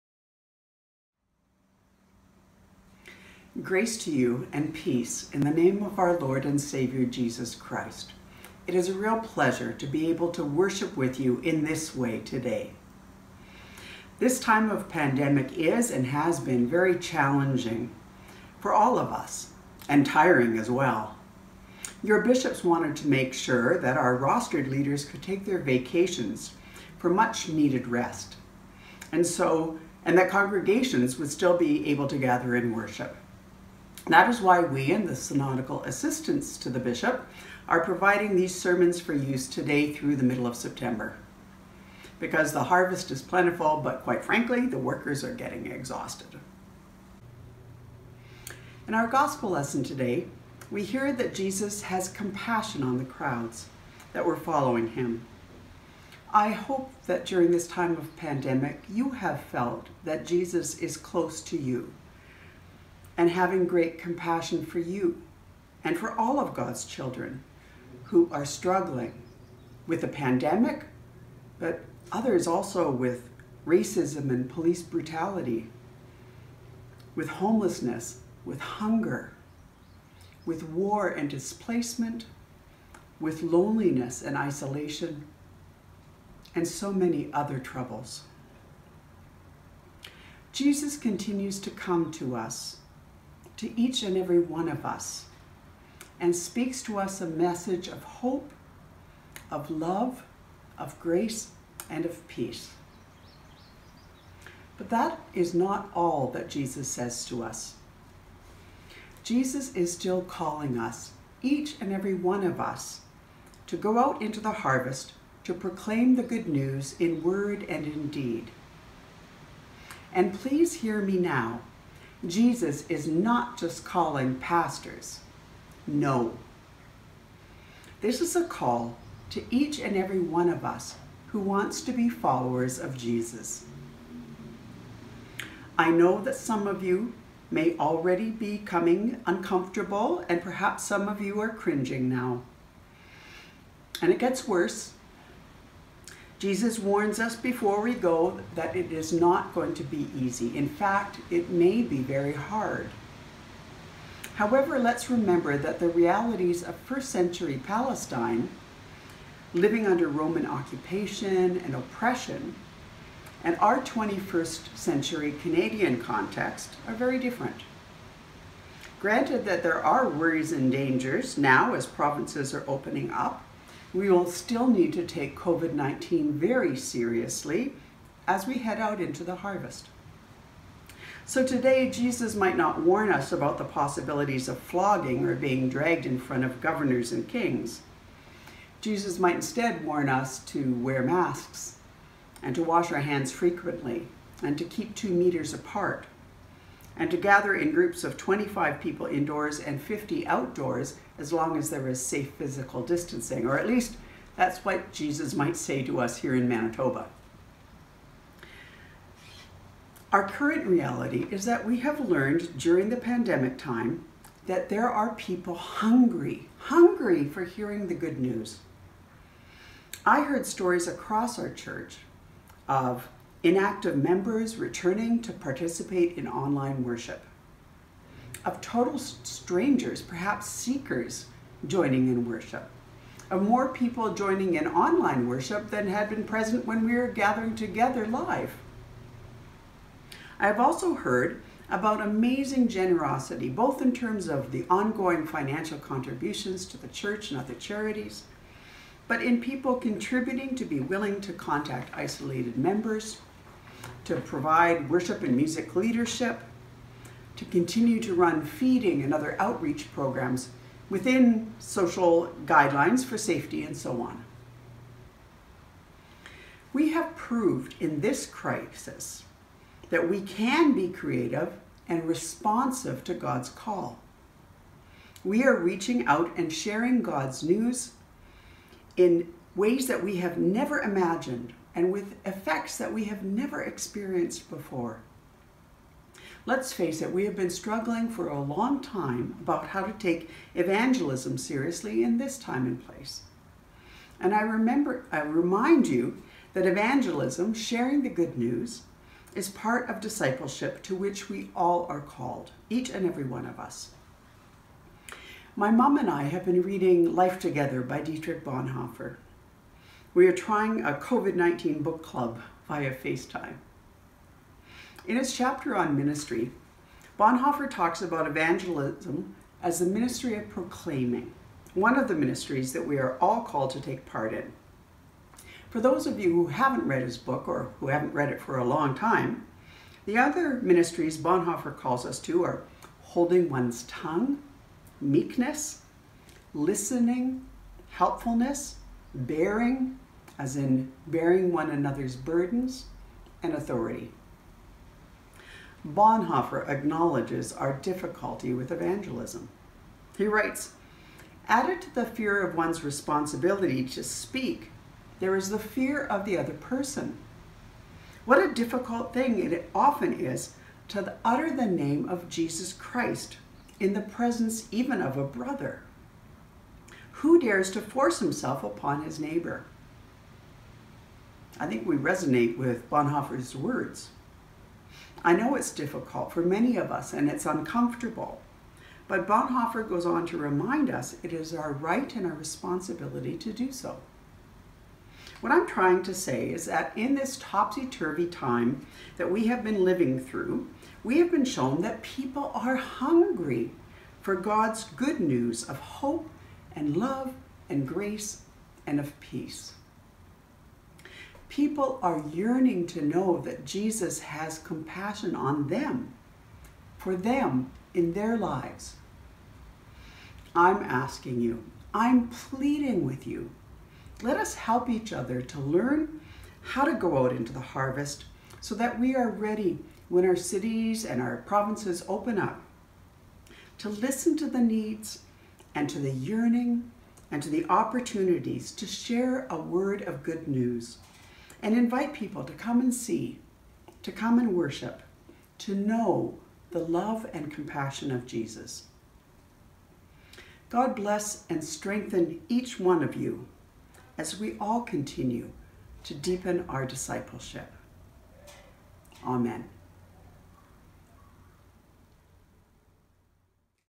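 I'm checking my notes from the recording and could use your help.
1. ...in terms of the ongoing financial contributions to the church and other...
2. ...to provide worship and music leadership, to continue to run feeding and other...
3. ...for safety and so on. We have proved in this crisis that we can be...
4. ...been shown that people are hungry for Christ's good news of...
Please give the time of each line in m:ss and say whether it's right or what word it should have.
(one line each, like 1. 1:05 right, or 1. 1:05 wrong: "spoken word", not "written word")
1. 4:03 right
2. 4:14 right
3. 4:23 right
4. 6:31 wrong: "God", not "Christ".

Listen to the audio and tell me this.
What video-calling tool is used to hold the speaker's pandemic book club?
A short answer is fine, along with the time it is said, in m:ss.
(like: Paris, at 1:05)
FaceTime, at 5:12.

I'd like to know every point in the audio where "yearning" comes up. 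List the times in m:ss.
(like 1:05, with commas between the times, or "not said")
6:42, 7:06.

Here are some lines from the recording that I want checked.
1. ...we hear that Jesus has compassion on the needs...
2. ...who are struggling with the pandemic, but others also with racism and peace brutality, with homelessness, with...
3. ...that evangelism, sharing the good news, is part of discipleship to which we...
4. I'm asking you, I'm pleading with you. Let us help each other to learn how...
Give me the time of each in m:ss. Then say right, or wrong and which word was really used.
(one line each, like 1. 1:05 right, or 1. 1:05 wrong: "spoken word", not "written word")
1. 0:50 wrong: "crowds", not "needs"
2. 1:08 wrong: "police", not "peace"
3. 4:56 right
4. 6:50 right.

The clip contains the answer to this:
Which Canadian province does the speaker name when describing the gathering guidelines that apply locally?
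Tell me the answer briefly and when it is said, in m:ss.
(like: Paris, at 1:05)
Manitoba, at 3:26.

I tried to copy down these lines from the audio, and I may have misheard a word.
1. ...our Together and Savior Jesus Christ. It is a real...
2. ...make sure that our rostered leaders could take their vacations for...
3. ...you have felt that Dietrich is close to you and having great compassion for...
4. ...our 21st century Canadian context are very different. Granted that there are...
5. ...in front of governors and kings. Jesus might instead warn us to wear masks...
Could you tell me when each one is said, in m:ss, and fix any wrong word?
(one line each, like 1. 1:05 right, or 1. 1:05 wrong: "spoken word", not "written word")
1. 0:05 wrong: "Lord", not "Together"
2. 0:23 right
3. 0:58 wrong: "Jesus", not "Dietrich"
4. 2:43 right
5. 3:06 right.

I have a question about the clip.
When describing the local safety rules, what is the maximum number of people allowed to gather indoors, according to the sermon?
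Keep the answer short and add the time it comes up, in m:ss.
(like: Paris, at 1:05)
25, at 3:18.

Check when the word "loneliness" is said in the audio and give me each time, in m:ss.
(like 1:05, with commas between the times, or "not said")
1:23.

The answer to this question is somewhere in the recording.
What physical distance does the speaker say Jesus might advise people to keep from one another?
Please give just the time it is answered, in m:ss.
3:14.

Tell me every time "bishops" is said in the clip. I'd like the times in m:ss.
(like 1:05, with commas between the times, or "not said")
0:22, 0:36.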